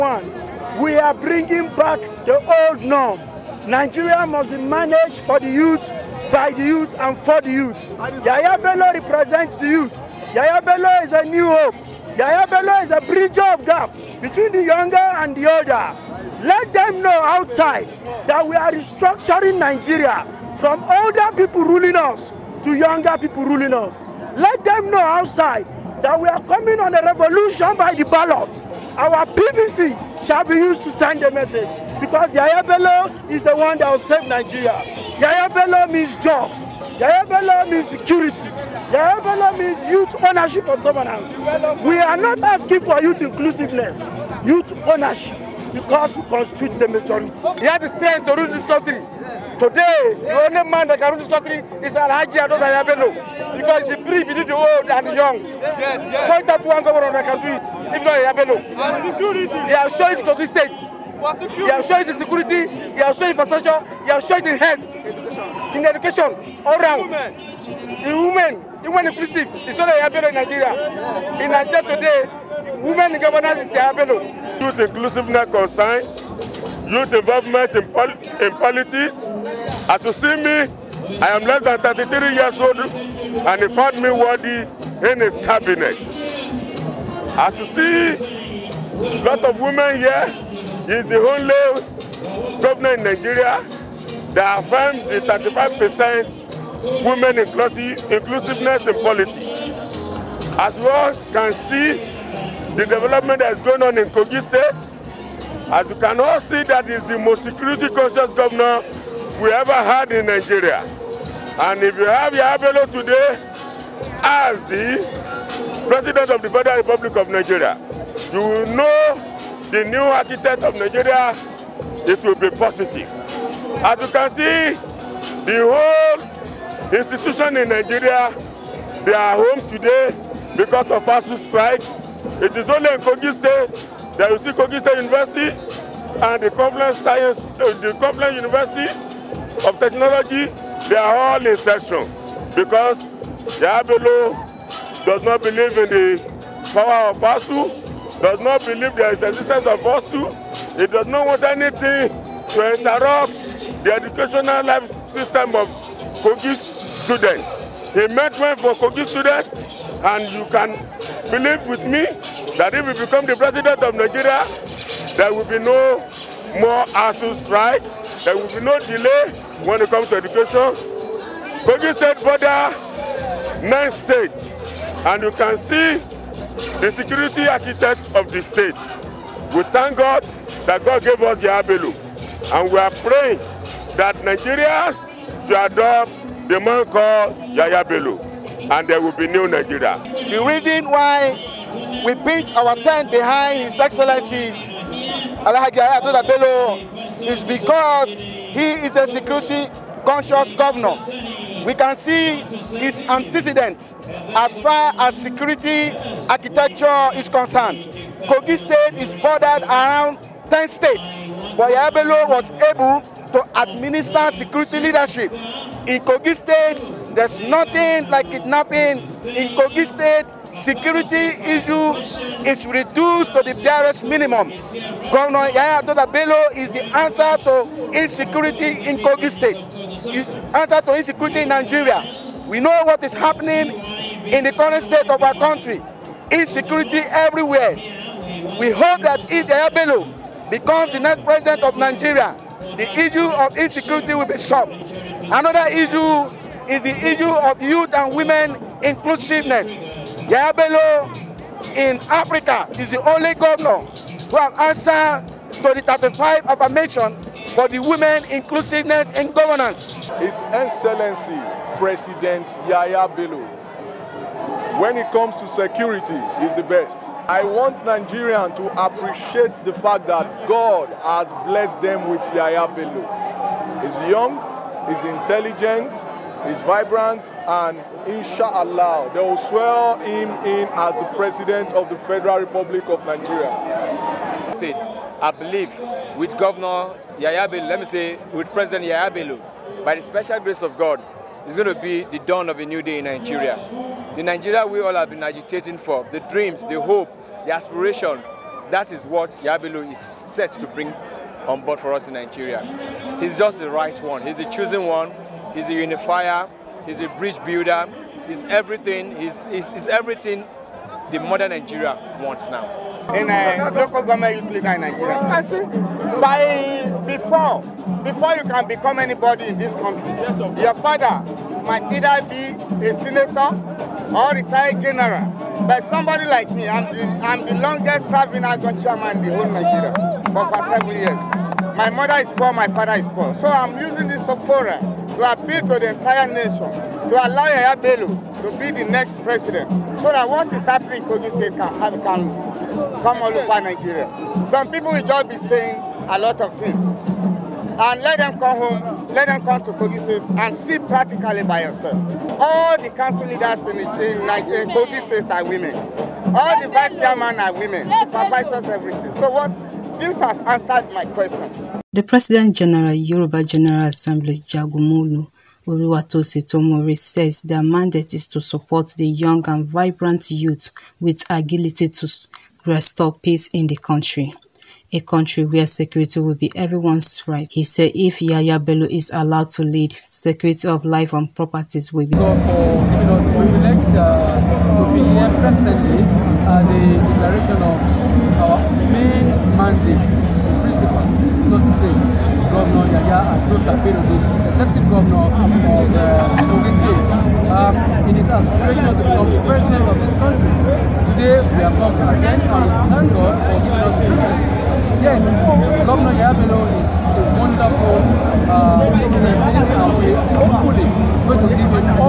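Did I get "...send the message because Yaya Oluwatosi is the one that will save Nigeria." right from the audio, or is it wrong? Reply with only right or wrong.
wrong.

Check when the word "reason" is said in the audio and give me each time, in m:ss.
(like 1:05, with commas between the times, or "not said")
3:10.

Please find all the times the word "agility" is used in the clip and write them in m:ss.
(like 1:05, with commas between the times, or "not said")
6:11.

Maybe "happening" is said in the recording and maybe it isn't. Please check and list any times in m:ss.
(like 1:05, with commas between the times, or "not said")
3:53, 5:40.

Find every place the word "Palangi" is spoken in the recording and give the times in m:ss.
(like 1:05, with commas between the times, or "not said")
not said.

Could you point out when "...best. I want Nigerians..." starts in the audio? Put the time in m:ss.
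4:26.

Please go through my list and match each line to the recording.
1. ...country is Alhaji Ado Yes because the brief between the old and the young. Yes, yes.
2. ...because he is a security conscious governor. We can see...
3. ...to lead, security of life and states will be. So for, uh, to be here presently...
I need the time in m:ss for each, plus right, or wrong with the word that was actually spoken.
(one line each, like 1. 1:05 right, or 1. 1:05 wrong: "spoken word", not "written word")
1. 0:51 wrong: "Yabelo", not "Yes"
2. 3:17 right
3. 6:19 wrong: "properties", not "states".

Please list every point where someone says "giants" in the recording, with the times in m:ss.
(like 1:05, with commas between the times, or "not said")
not said.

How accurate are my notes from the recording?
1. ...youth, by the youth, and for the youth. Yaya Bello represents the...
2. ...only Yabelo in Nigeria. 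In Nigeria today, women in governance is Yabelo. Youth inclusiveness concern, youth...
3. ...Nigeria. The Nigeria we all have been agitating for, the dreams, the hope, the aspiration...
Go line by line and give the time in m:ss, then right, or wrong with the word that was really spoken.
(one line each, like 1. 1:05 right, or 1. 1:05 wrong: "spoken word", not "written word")
1. 0:05 right
2. 1:09 right
3. 4:53 right.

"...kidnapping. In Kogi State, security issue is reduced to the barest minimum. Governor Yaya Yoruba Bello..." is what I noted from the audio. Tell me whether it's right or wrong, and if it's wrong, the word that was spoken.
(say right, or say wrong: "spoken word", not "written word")
wrong: "Doda", not "Yoruba".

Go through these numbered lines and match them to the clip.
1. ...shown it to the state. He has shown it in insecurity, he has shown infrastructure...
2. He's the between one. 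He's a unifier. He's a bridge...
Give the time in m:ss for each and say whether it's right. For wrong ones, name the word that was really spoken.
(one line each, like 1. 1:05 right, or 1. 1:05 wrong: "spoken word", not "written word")
1. 0:59 wrong: "security", not "insecurity"
2. 5:04 wrong: "chosen", not "between".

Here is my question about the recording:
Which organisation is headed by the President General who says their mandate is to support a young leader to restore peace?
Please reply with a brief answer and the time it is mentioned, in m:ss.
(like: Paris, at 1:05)
Yoruba General Assembly, at 6:02.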